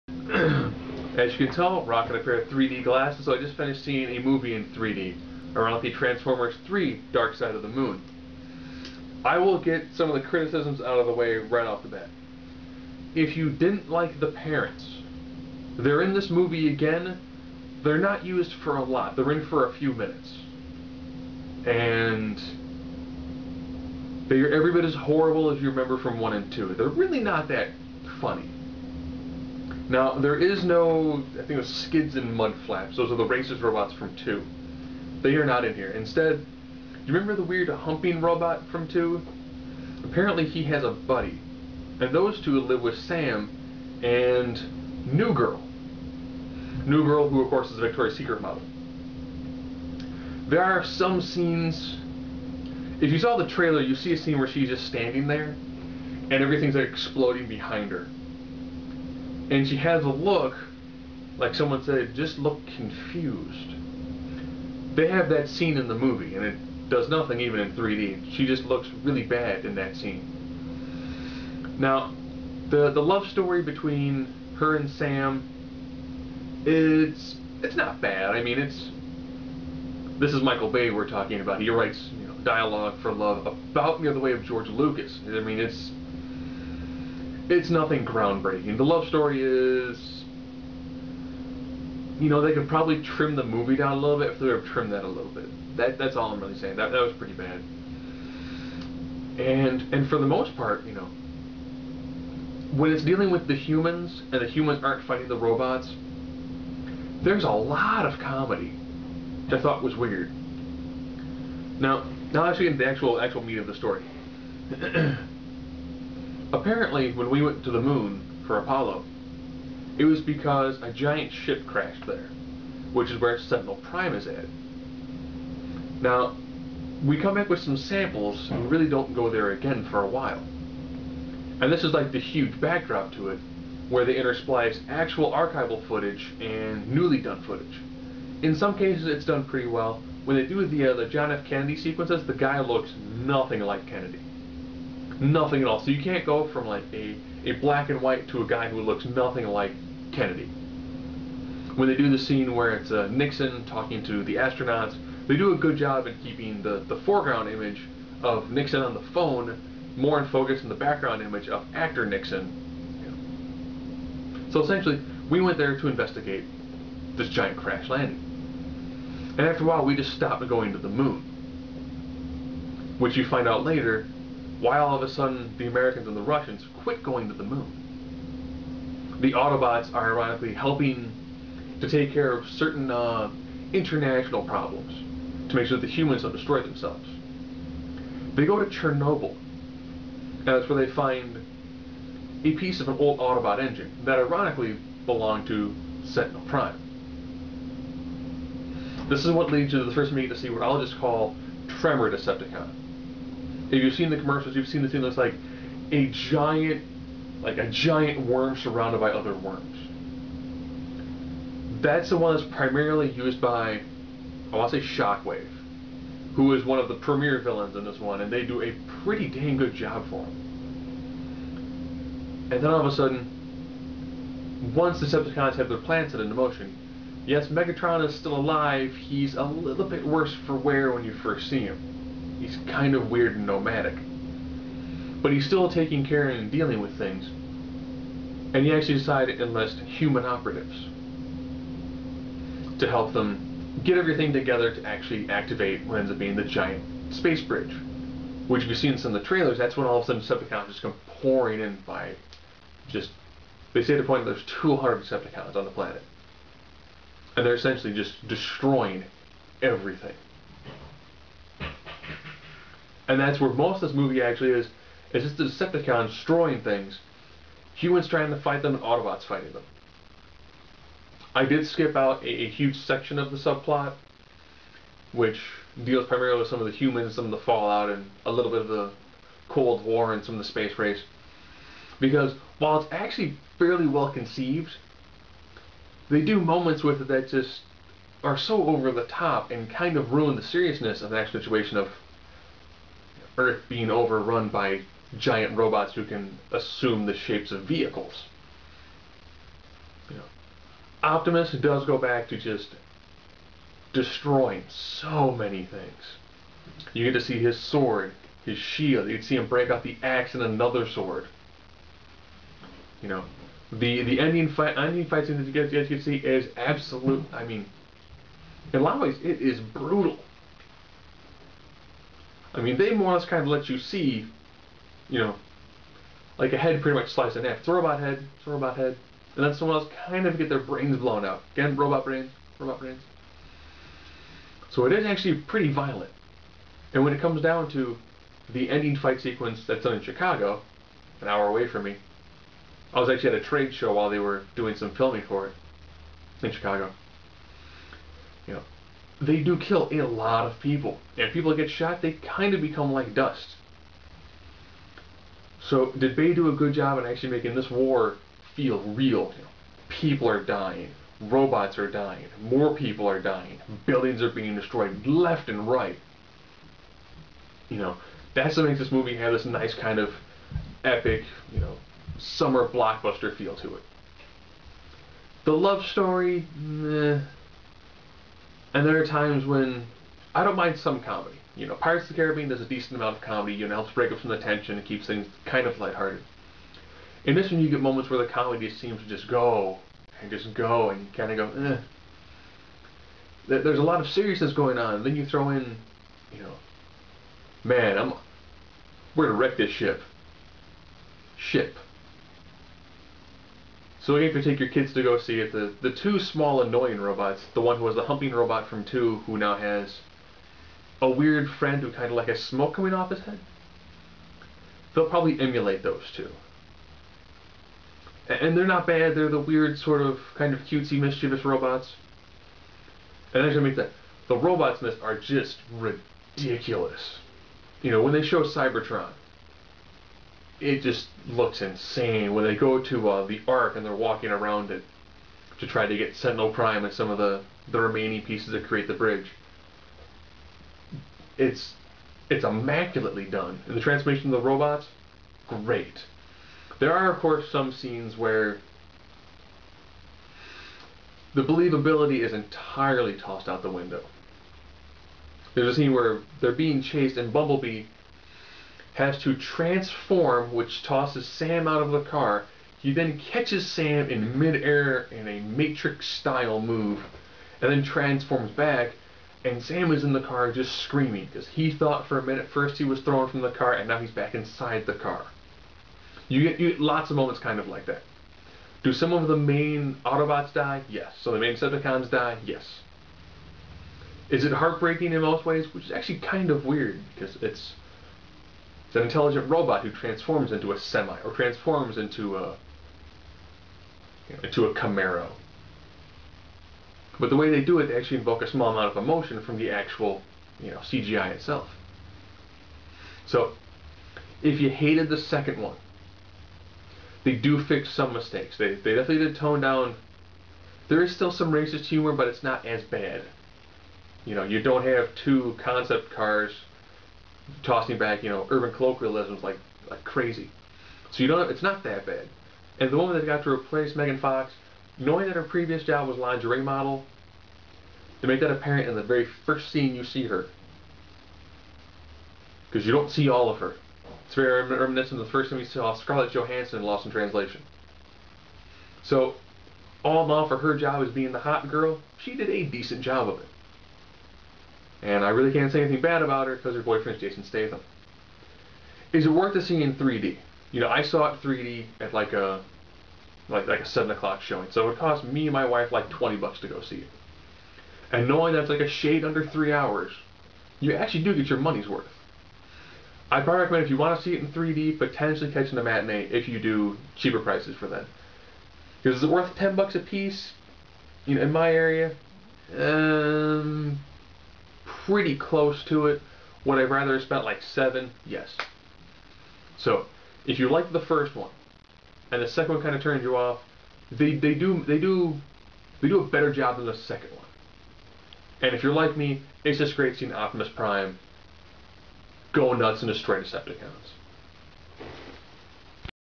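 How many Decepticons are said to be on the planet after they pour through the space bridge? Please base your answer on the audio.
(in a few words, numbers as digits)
200.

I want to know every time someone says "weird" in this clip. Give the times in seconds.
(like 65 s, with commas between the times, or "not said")
37 s, 109 s, 233 s, 411 s, 419 s, 486 s.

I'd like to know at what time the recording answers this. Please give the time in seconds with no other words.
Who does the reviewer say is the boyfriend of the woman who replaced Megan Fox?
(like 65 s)
547 s.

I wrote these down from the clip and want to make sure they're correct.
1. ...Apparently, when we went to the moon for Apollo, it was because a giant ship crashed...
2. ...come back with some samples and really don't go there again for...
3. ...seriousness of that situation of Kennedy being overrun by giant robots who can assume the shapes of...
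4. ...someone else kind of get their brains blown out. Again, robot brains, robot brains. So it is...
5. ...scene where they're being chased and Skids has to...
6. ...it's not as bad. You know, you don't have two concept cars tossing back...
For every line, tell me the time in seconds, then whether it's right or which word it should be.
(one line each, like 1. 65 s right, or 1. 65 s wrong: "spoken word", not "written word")
1. 116 s right
2. 127 s right
3. 290 s wrong: "Earth", not "Kennedy"
4. 329 s right
5. 455 s wrong: "Bumblebee", not "Skids"
6. 512 s right.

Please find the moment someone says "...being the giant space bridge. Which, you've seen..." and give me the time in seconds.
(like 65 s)
246 s.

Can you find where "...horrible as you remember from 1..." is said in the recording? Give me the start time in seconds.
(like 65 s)
24 s.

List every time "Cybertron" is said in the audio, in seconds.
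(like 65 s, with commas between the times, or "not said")
428 s.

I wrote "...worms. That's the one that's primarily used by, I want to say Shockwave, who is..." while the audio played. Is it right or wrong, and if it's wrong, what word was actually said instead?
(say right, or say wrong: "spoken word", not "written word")
right.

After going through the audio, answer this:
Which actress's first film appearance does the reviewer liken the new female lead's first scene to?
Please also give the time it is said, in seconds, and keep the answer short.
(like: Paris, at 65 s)
Scarlett Johansson, at 535 s.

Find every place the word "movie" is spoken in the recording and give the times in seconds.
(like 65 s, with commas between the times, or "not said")
4 s, 16 s, 65 s, 93 s, 263 s, 368 s.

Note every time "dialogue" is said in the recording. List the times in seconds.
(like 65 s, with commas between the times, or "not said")
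82 s.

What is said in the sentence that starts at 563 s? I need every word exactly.
I probably recommend if you want to see it in 3D, potentially catching the matinee if you do cheaper prices for that.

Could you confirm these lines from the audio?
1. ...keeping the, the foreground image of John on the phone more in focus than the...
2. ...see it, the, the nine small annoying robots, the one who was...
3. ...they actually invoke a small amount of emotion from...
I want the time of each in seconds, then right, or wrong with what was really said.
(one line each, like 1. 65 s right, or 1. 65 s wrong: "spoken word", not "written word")
1. 156 s wrong: "Nixon", not "John"
2. 405 s wrong: "two", not "nine"
3. 497 s right.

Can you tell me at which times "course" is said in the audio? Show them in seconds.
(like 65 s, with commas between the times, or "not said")
47 s, 447 s.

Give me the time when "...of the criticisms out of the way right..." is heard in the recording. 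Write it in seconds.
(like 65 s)
10 s.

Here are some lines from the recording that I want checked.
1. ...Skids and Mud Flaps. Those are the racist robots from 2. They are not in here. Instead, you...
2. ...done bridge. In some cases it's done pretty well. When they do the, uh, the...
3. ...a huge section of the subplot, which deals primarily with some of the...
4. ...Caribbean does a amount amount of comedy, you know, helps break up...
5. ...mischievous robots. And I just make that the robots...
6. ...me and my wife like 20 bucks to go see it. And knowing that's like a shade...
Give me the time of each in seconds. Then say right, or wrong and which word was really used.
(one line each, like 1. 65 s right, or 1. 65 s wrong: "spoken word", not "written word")
1. 31 s right
2. 137 s wrong: "footage", not "bridge"
3. 272 s right
4. 382 s wrong: "decent", not "amount"
5. 420 s right
6. 555 s right.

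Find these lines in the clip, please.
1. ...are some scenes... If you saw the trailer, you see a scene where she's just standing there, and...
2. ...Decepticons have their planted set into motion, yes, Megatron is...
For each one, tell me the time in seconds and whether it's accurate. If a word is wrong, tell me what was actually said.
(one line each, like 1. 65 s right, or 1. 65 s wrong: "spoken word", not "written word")
1. 50 s right
2. 225 s right.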